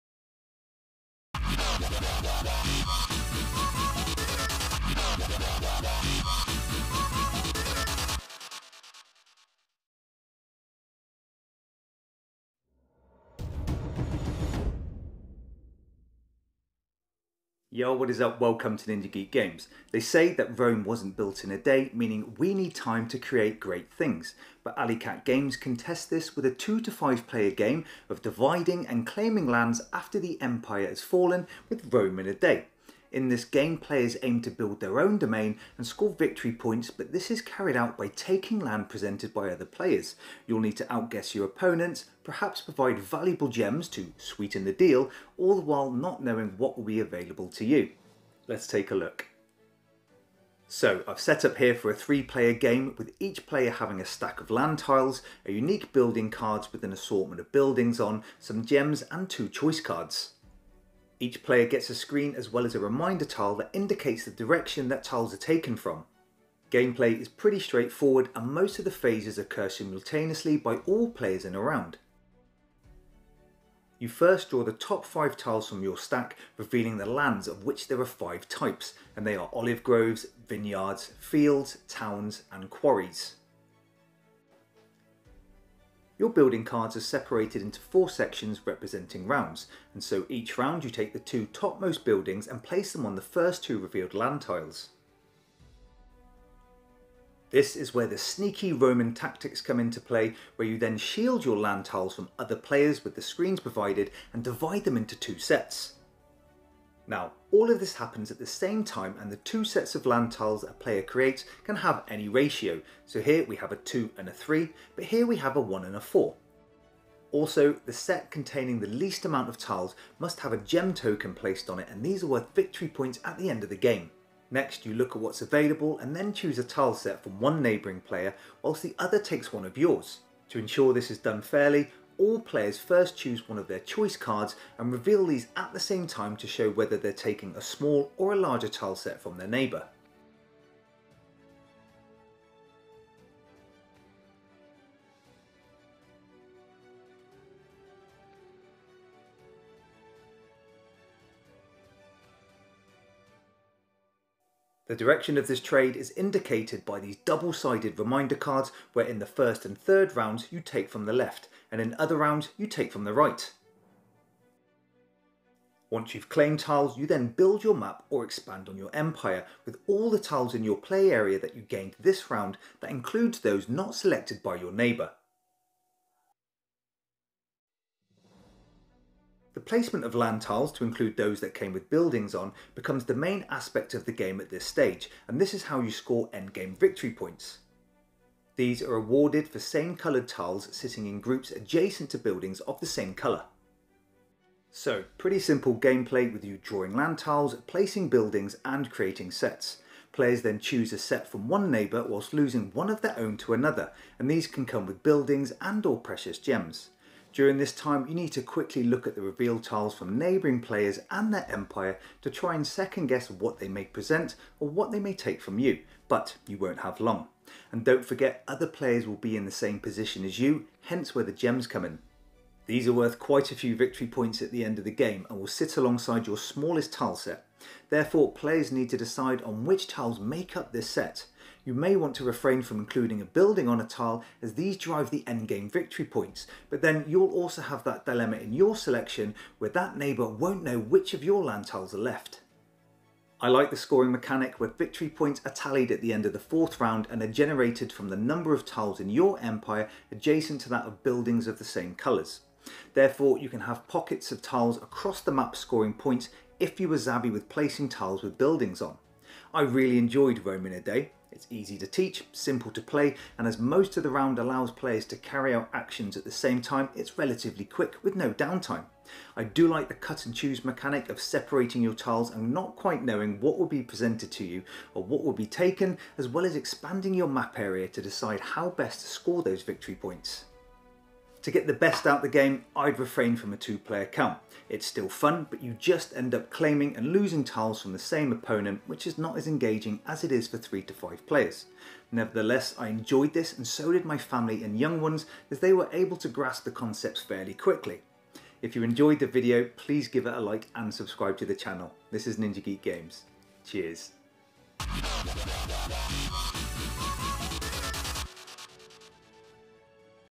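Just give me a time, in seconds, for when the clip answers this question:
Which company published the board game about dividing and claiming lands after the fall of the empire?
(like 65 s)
24 s.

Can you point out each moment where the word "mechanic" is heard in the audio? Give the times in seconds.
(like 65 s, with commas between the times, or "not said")
244 s, 270 s.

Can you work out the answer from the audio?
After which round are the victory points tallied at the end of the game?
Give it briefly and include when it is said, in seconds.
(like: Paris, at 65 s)
Fourth round, at 246 s.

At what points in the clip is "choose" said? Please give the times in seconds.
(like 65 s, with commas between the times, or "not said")
126 s, 133 s, 200 s, 270 s.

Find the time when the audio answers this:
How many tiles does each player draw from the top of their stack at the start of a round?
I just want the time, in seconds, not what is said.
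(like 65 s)
74 s.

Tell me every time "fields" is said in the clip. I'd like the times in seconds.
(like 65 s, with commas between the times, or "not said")
81 s.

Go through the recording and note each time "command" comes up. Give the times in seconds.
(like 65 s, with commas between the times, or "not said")
not said.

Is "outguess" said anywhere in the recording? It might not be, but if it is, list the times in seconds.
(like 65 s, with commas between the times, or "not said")
40 s.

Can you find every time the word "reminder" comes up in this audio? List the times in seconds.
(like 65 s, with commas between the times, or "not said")
62 s, 157 s.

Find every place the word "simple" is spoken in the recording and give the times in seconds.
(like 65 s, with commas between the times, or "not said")
195 s, 262 s.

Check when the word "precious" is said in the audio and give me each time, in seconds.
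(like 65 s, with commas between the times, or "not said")
205 s.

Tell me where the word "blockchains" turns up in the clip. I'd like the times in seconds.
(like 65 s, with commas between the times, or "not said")
not said.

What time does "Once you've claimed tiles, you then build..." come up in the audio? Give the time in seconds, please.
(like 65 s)
165 s.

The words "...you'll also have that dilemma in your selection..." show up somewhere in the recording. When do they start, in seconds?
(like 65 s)
237 s.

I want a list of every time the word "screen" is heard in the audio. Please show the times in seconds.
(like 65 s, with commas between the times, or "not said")
61 s, 103 s.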